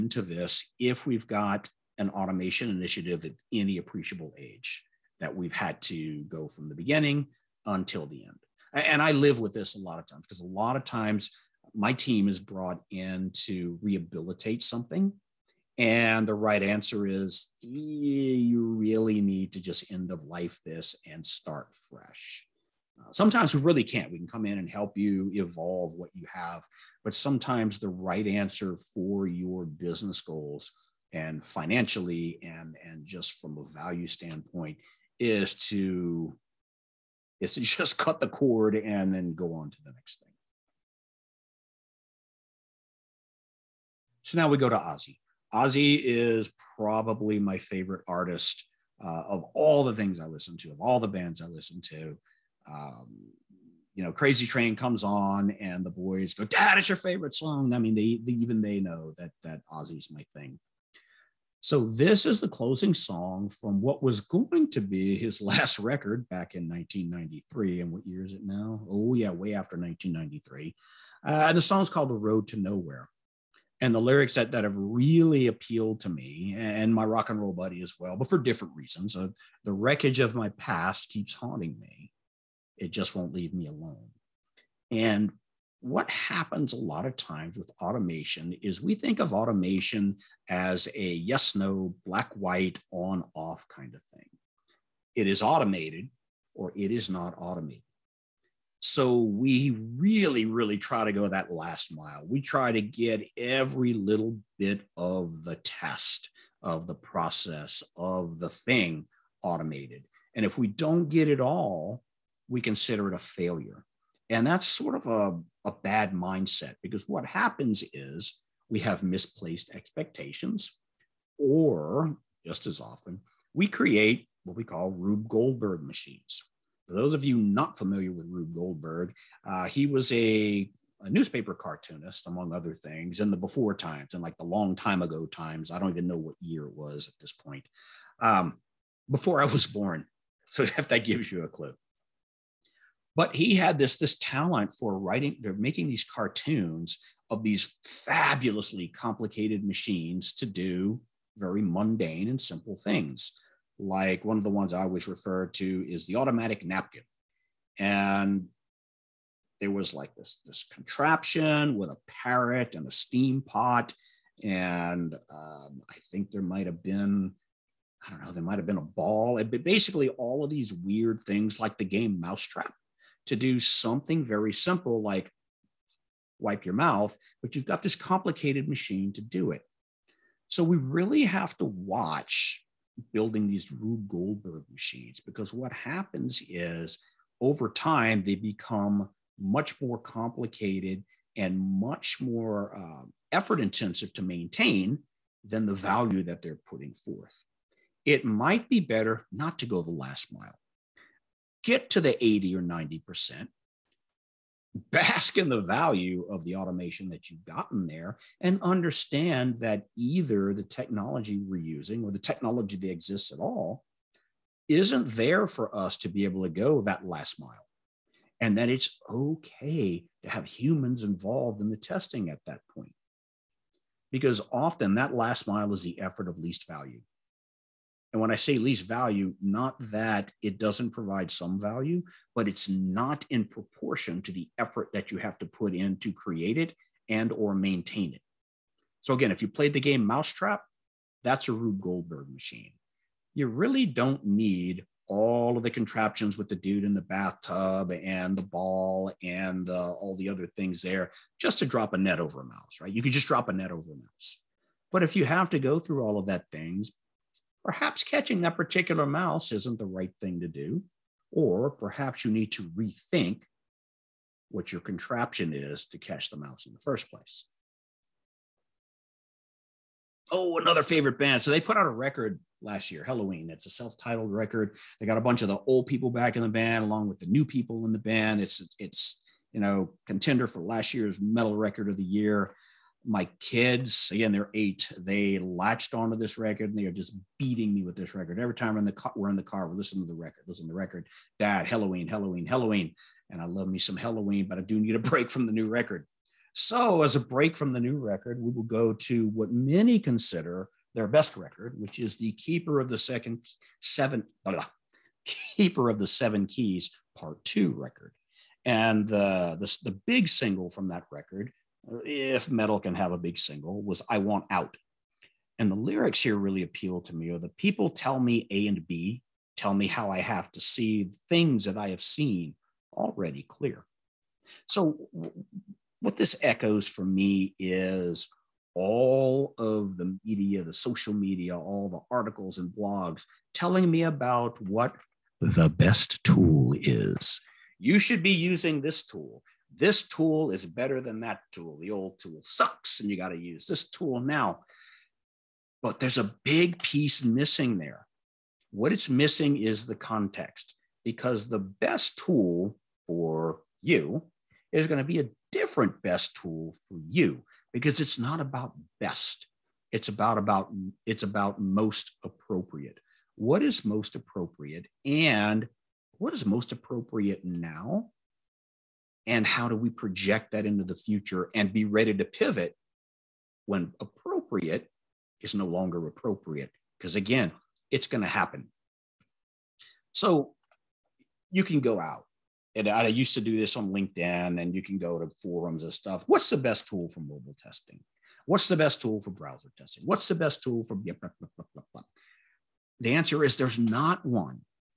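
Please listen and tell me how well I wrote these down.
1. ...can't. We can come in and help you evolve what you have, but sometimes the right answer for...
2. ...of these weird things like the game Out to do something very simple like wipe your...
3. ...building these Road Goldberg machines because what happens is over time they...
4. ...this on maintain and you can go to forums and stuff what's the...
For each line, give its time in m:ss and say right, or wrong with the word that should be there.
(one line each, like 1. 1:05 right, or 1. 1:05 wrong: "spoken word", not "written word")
1. 0:23 right
2. 2:50 wrong: "Mousetrap", not "Out"
3. 3:03 wrong: "Rube", not "Road"
4. 6:23 wrong: "linkedin", not "maintain".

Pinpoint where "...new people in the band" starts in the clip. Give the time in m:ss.
4:37.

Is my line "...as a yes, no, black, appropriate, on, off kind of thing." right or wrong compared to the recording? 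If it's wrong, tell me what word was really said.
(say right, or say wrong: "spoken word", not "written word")
wrong: "white", not "appropriate".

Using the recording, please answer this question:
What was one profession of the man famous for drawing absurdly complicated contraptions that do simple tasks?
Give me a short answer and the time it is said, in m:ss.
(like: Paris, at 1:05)
newspaper cartoonist, at 2:11.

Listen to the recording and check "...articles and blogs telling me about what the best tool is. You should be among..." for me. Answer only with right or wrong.
wrong.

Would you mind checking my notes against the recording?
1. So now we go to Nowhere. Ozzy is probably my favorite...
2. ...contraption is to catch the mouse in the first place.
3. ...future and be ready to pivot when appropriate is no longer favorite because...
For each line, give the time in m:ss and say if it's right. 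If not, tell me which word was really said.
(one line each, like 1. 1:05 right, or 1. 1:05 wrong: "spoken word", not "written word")
1. 0:44 wrong: "Ozzy", not "Nowhere"
2. 4:24 right
3. 6:10 wrong: "appropriate", not "favorite".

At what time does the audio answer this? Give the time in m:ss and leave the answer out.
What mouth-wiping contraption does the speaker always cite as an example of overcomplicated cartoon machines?
2:36.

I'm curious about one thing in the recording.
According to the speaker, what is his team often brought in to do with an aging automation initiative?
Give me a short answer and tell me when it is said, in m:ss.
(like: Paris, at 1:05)
rehabilitate, at 0:13.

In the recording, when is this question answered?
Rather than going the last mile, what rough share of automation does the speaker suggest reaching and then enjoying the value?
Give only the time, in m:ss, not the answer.
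3:22.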